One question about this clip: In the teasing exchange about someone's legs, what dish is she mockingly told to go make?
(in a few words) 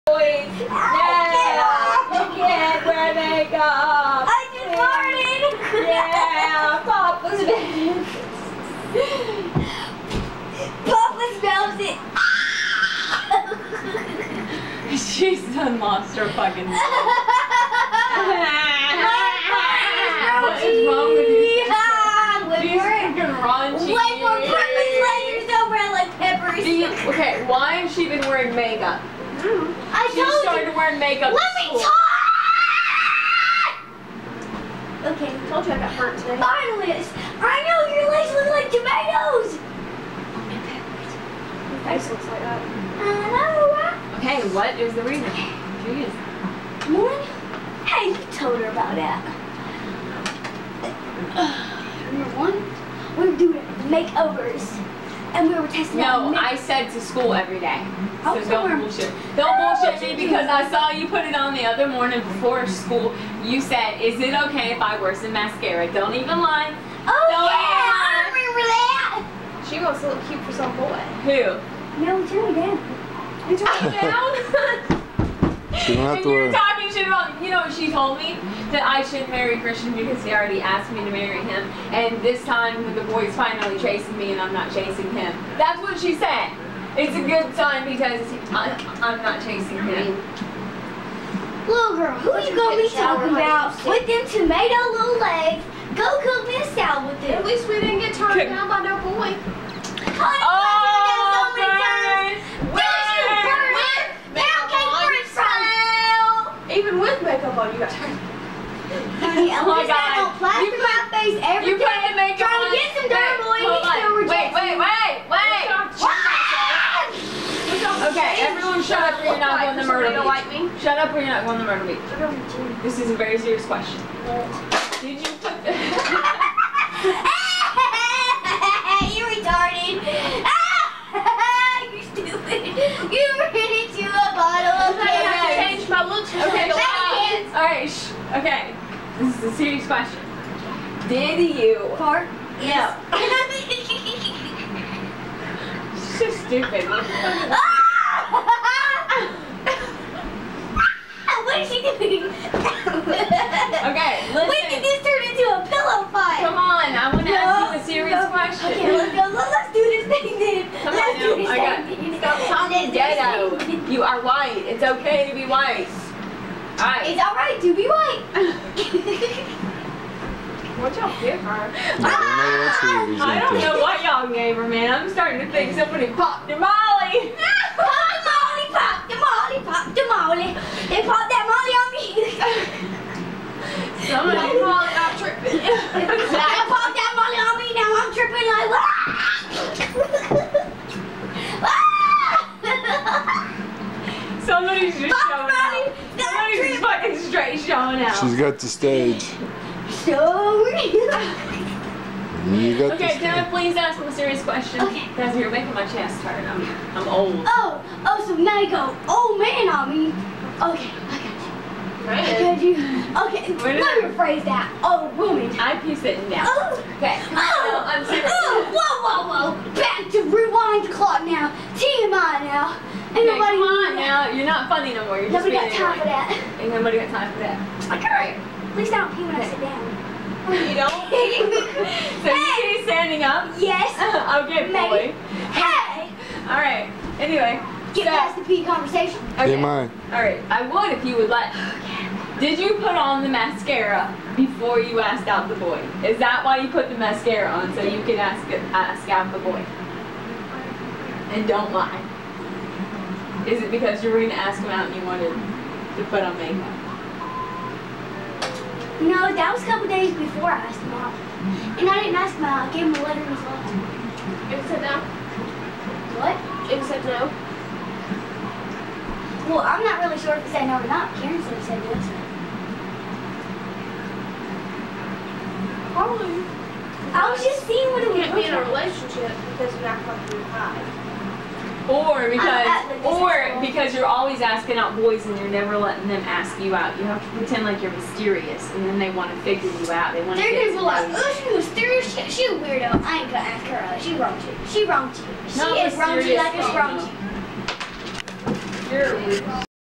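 salad.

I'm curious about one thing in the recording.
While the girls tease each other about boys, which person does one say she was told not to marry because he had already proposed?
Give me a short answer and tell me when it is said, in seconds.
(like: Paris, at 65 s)
Christian, at 79 s.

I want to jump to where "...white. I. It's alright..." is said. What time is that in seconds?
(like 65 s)
165 s.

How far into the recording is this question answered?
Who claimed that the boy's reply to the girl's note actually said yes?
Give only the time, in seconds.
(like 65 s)
271 s.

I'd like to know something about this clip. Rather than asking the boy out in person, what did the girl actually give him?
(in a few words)
A letter.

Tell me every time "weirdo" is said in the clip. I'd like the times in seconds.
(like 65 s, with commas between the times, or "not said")
292 s, 299 s.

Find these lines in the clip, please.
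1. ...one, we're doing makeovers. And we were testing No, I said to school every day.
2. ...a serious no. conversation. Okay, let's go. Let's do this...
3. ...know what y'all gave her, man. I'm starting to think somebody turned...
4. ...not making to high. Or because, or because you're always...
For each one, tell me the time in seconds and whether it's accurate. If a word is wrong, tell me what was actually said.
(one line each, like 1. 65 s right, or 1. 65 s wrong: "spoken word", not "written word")
1. 52 s right
2. 157 s wrong: "question", not "conversation"
3. 173 s wrong: "popped", not "turned"
4. 279 s wrong: "coming", not "making".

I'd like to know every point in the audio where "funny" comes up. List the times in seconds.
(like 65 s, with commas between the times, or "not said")
224 s.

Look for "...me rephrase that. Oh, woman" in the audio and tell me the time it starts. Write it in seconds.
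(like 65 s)
213 s.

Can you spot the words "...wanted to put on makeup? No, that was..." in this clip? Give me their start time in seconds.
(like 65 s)
255 s.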